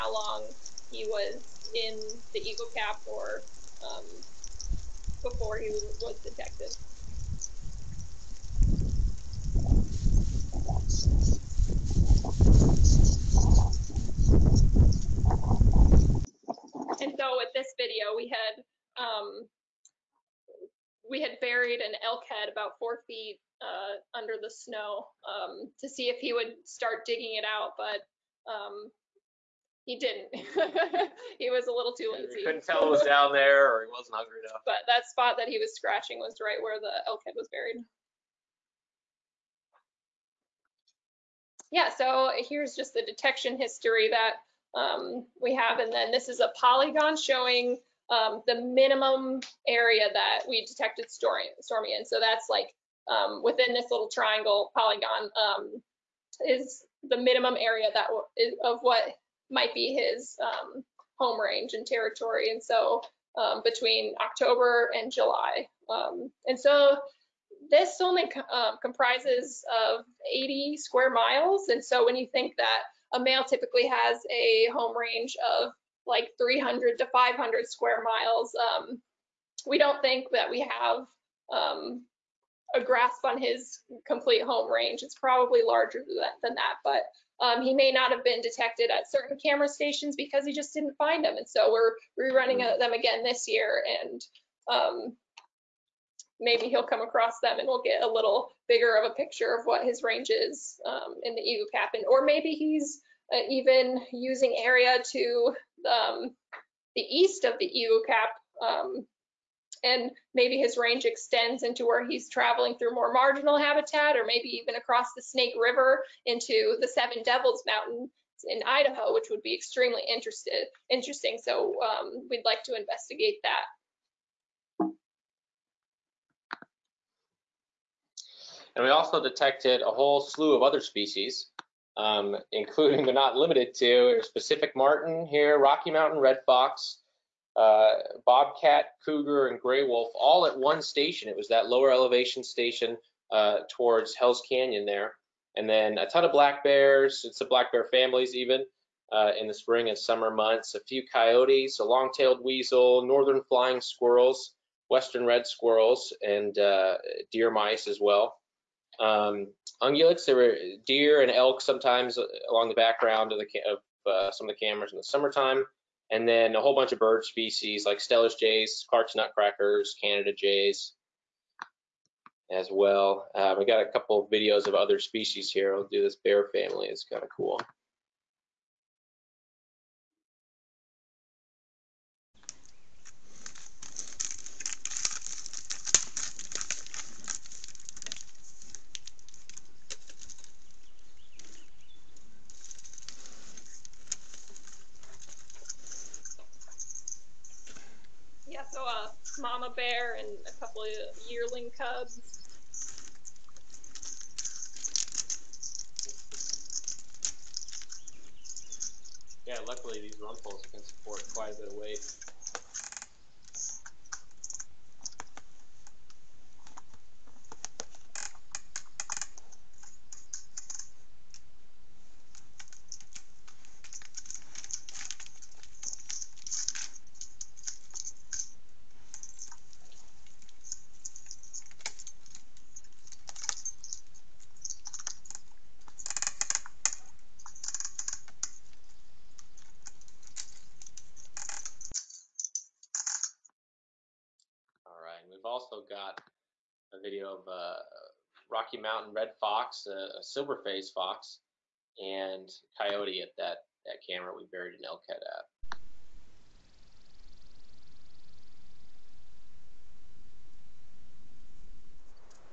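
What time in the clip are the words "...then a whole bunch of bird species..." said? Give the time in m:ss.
2:46.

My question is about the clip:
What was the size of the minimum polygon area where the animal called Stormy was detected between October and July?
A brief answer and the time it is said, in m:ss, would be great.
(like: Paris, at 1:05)
80 square miles, at 1:10.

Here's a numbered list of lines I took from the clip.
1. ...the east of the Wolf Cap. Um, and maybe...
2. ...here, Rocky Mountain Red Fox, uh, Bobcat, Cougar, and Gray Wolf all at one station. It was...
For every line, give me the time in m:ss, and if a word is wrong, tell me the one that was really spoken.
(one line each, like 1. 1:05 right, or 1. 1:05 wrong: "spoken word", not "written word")
1. 1:46 wrong: "Eagle", not "Wolf"
2. 2:15 right.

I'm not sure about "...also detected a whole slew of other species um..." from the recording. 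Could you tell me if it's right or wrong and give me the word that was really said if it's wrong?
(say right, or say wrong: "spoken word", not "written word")
right.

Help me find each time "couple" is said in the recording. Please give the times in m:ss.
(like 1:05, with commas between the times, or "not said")
2:53, 3:20.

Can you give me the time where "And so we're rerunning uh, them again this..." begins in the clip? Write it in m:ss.
1:31.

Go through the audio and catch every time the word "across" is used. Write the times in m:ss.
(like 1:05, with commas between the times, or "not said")
1:37, 1:54.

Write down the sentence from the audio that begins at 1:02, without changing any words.
And so um, between October and July.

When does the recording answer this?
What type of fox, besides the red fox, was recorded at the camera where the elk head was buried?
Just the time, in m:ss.
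4:10.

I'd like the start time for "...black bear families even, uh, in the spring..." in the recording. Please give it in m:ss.
2:27.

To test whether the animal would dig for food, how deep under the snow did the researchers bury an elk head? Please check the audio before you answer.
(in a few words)
4 feet.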